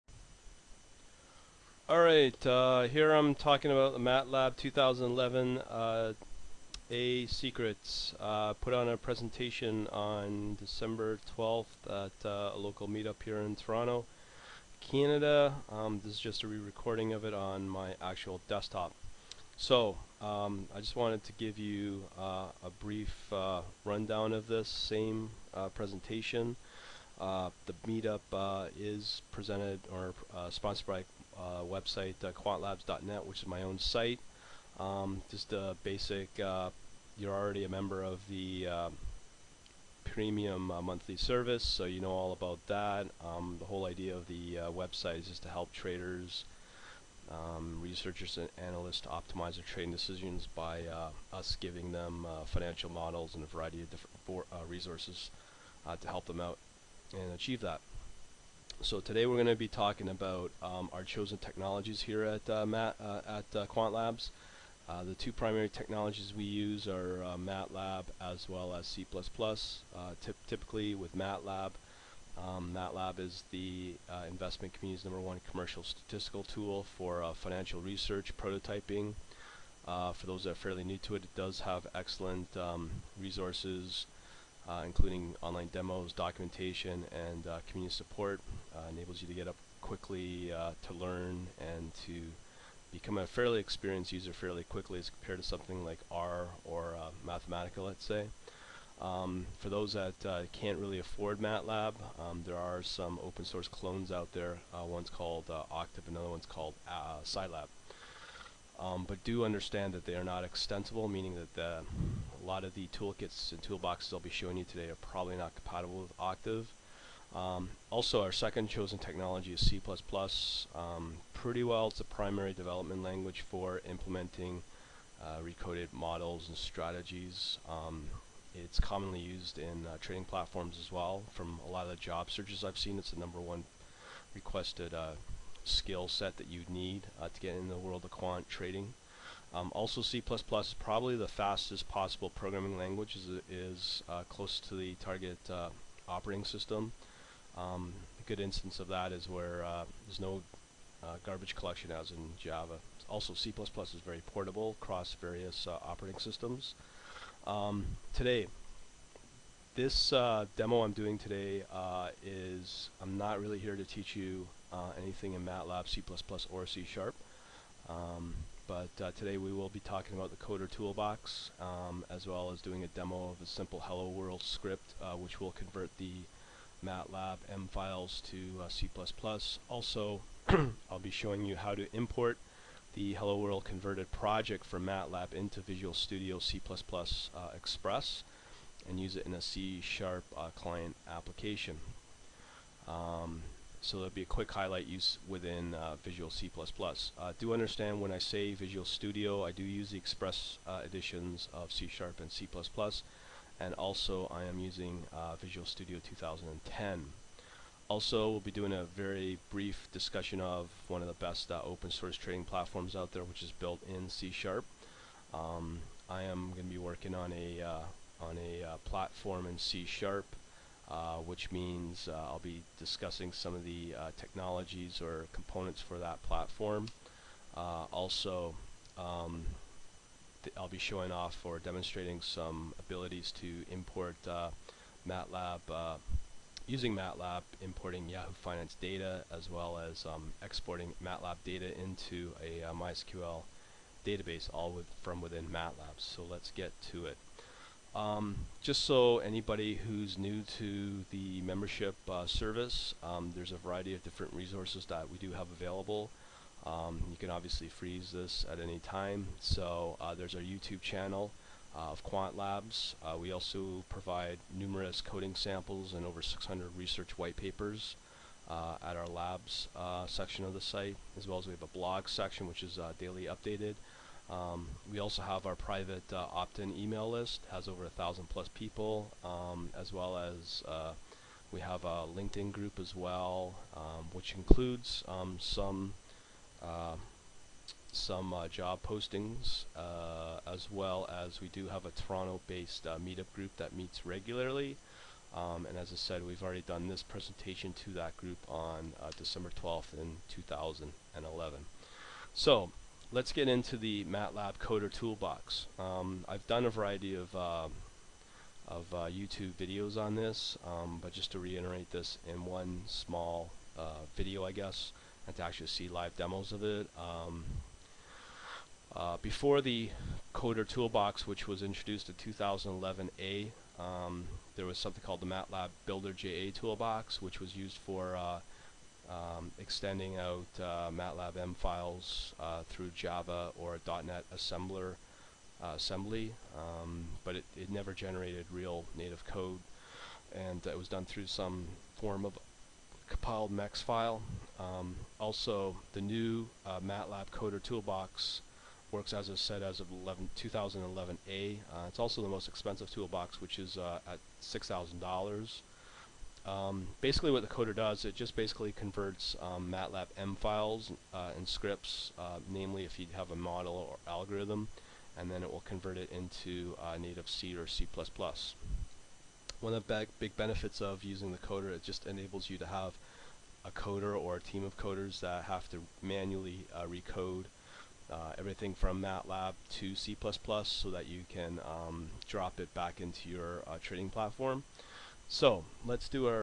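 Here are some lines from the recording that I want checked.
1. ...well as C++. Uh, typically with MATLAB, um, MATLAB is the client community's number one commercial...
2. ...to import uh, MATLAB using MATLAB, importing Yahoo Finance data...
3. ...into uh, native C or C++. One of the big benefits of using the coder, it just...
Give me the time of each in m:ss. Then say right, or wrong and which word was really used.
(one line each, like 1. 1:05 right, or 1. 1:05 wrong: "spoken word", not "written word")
1. 1:08 wrong: "investment", not "client"
2. 3:53 right
3. 6:06 right.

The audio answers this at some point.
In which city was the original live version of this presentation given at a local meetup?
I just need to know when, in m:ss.
0:13.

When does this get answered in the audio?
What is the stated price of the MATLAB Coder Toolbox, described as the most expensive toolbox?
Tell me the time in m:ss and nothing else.
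5:54.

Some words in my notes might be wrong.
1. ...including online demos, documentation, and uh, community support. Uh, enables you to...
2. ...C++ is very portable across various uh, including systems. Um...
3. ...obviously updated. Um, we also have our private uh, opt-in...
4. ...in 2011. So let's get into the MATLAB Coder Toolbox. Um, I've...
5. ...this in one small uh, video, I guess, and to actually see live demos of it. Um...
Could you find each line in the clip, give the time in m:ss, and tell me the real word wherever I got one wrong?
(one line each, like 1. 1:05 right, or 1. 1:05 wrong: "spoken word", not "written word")
1. 1:24 right
2. 2:33 wrong: "operating", not "including"
3. 4:32 wrong: "daily", not "obviously"
4. 4:59 right
5. 5:11 right.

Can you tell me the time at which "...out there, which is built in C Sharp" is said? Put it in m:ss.
3:32.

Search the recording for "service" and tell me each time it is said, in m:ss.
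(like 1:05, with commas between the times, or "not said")
0:41, 4:12.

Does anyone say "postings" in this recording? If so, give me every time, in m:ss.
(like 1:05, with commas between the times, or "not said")
4:48.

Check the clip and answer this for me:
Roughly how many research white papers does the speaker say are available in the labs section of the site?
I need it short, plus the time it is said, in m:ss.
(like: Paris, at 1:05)
over 600, at 4:26.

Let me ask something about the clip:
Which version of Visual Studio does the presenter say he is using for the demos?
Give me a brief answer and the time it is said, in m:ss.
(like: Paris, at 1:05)
Visual Studio 2010, at 3:25.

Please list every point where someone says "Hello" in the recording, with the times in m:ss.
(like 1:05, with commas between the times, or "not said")
2:53, 3:03.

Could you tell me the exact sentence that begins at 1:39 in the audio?
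Um, for those that can't really afford MATLAB, um, there are some open source clones out there.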